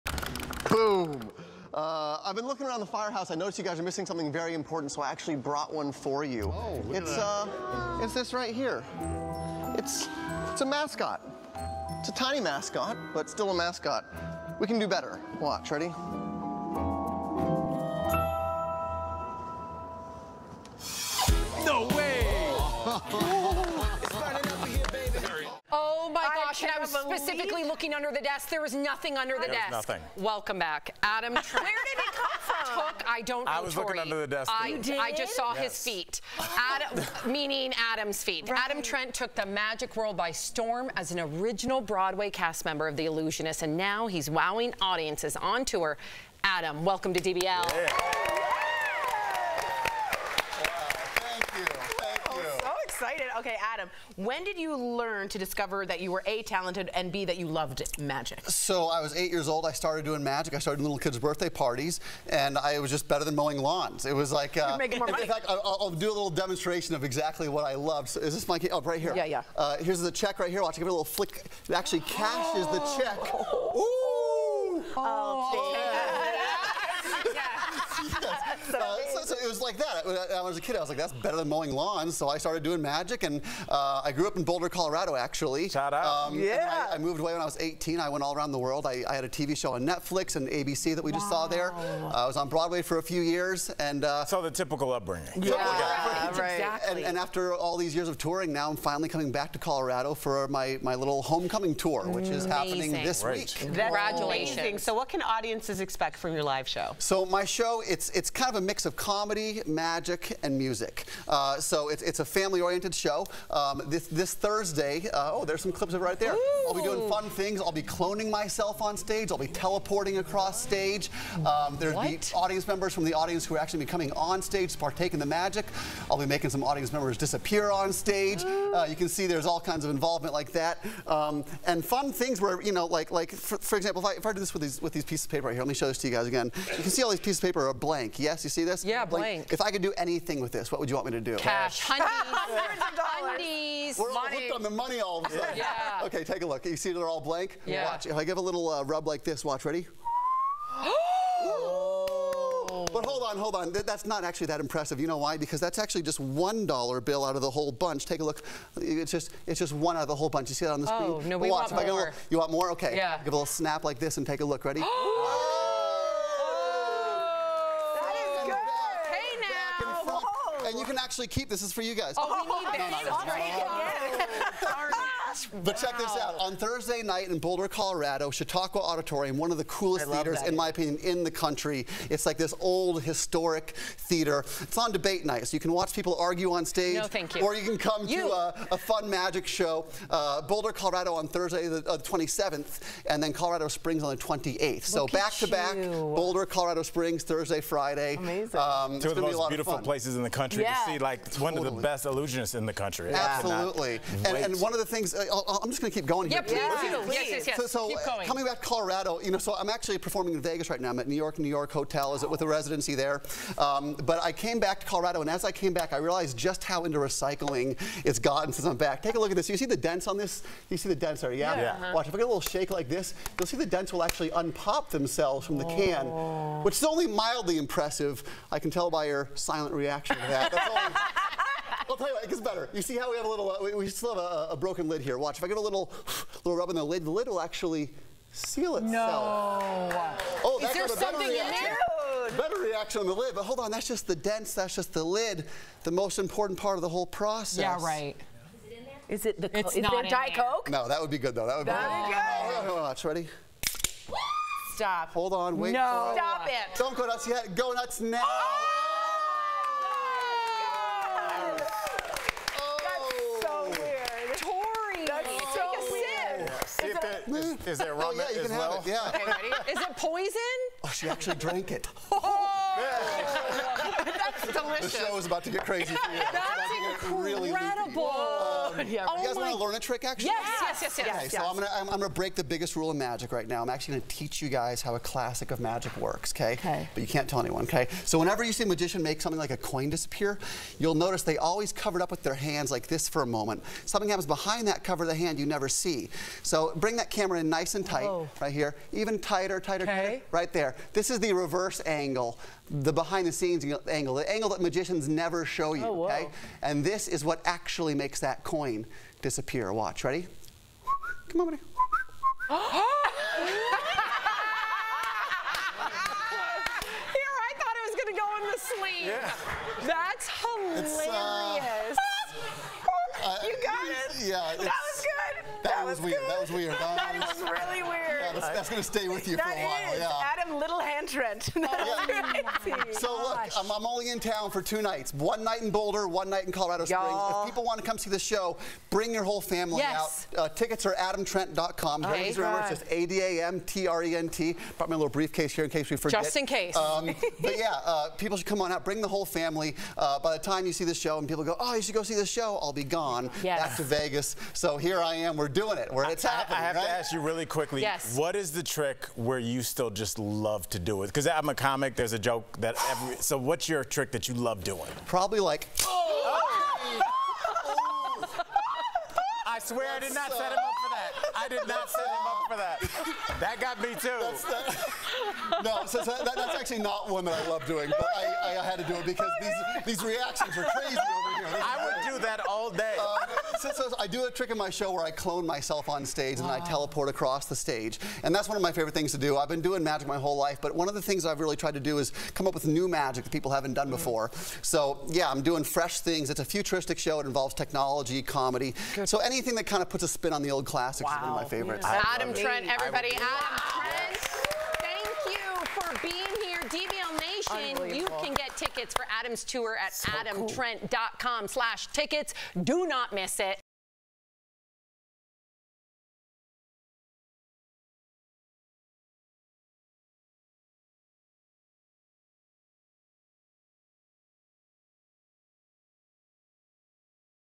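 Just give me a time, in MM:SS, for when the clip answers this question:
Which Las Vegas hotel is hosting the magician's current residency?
03:31.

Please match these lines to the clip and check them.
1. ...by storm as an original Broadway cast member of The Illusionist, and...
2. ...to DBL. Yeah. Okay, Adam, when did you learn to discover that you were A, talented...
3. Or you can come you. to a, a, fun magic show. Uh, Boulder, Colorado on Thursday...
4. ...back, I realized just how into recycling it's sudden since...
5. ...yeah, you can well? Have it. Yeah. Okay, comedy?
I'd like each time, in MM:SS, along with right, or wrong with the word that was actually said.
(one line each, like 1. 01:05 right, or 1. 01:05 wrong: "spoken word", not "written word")
1. 00:40 right
2. 00:47 right
3. 03:07 right
4. 03:35 wrong: "gotten", not "sudden"
5. 04:28 wrong: "ready", not "comedy".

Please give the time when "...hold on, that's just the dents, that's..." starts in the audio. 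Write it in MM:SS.
04:03.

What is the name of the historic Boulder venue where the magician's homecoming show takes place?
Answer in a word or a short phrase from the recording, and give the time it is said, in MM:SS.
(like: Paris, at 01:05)
Chautauqua Auditorium, at 02:58.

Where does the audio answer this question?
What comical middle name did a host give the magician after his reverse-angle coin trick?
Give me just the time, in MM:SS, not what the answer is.
05:30.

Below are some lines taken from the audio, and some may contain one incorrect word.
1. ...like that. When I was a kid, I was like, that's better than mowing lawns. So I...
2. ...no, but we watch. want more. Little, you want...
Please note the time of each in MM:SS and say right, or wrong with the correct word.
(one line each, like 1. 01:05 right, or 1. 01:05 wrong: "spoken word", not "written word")
1. 01:19 right
2. 02:41 right.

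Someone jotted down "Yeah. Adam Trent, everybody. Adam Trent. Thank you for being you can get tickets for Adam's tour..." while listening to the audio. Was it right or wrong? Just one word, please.
right.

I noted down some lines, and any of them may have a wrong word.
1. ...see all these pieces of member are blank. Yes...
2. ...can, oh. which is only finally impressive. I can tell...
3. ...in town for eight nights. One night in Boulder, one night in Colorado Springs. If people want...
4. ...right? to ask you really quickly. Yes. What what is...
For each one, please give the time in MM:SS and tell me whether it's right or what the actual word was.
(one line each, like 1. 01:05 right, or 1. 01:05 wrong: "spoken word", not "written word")
1. 02:16 wrong: "paper", not "member"
2. 03:45 wrong: "mildly", not "finally"
3. 05:34 wrong: "two", not "eight"
4. 05:56 right.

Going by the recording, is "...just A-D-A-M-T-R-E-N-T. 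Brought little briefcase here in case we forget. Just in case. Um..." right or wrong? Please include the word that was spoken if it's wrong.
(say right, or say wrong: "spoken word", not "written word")
right.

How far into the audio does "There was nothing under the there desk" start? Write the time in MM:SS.
00:28.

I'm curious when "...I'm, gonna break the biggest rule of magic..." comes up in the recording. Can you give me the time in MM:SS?
04:41.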